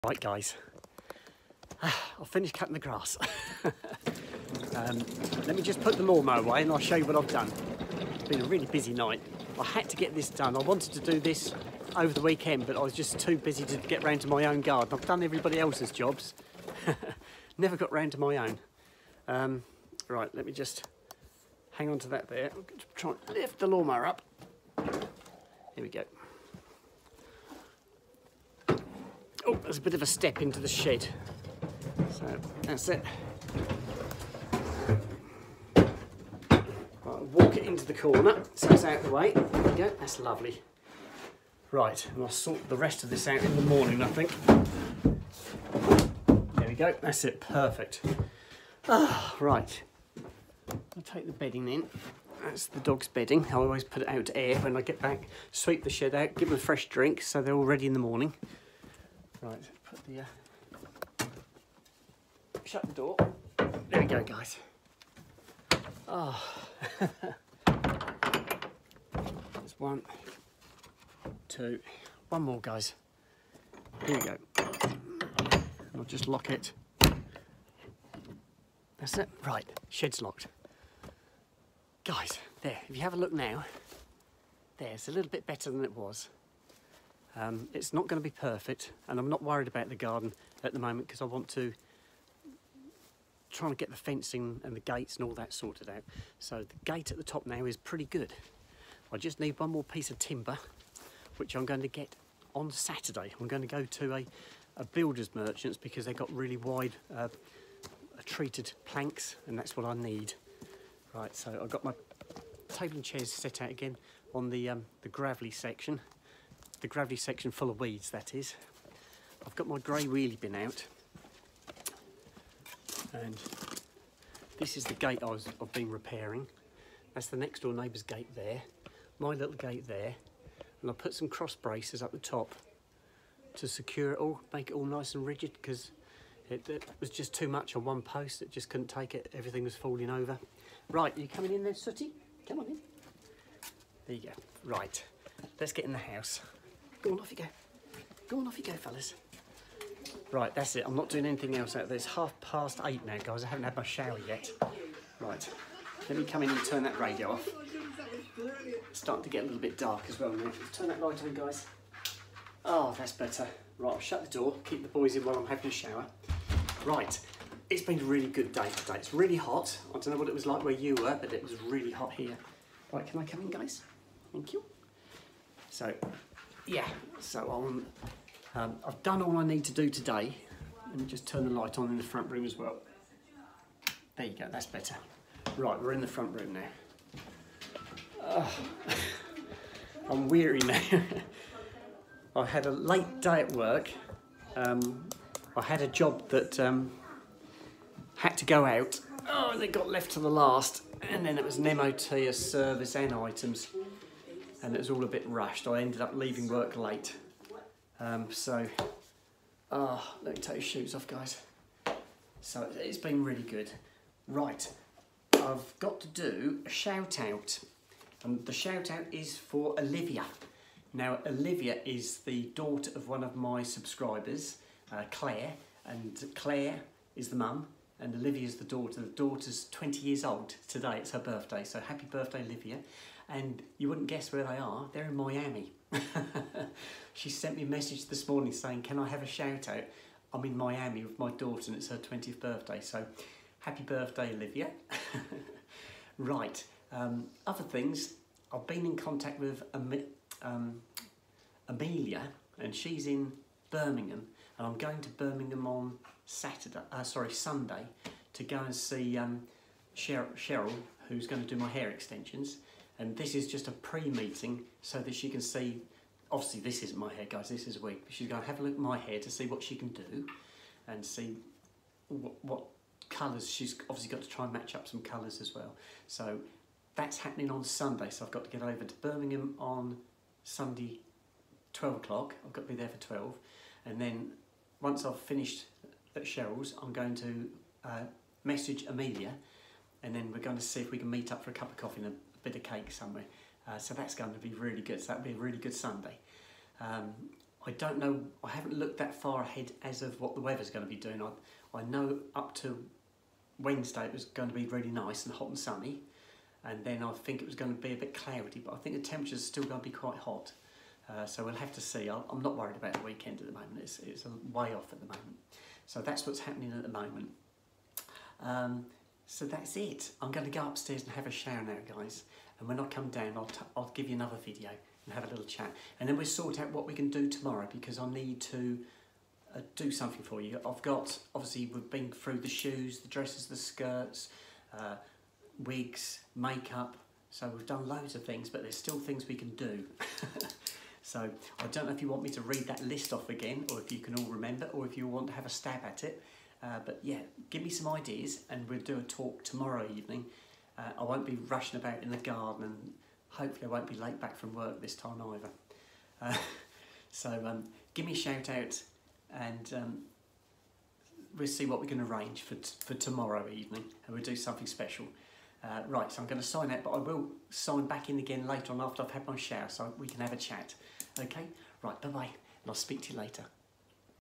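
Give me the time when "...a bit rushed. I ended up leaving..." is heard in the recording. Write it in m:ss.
3:25.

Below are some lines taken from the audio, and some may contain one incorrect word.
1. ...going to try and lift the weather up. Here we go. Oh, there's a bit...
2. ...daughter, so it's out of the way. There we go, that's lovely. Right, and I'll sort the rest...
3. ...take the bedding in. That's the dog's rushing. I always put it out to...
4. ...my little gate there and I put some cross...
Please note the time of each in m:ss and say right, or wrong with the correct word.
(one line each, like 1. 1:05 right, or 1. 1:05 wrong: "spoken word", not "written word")
1. 0:22 wrong: "lawnmower", not "weather"
2. 0:37 wrong: "corner", not "daughter"
3. 0:51 wrong: "bedding", not "rushing"
4. 2:09 right.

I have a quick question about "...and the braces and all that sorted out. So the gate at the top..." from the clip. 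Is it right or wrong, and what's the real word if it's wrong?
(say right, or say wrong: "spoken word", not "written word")
wrong: "gates", not "braces".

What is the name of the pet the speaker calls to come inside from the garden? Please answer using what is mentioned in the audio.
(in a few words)
Sooty.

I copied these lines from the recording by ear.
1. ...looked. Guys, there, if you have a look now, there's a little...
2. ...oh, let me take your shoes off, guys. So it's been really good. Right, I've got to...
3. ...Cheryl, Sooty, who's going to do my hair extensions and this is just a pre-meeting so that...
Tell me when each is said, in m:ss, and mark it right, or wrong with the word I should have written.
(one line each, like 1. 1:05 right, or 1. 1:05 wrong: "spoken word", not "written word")
1. 1:20 wrong: "locked", not "looked"
2. 3:30 right
3. 4:19 wrong: "Cheryl", not "Sooty".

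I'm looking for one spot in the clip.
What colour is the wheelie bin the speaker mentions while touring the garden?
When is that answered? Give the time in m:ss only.
1:59.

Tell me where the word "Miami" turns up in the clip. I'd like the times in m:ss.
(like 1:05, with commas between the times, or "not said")
3:55, 4:00.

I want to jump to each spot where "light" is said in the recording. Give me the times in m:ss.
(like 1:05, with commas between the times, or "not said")
2:41, 3:01.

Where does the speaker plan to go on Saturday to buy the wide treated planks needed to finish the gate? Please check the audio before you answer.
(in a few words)
builder's merchants.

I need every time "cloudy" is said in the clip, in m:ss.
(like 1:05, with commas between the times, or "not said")
5:08.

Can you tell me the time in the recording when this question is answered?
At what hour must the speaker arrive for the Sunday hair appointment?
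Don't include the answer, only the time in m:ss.
4:41.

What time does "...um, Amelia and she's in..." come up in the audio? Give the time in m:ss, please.
4:10.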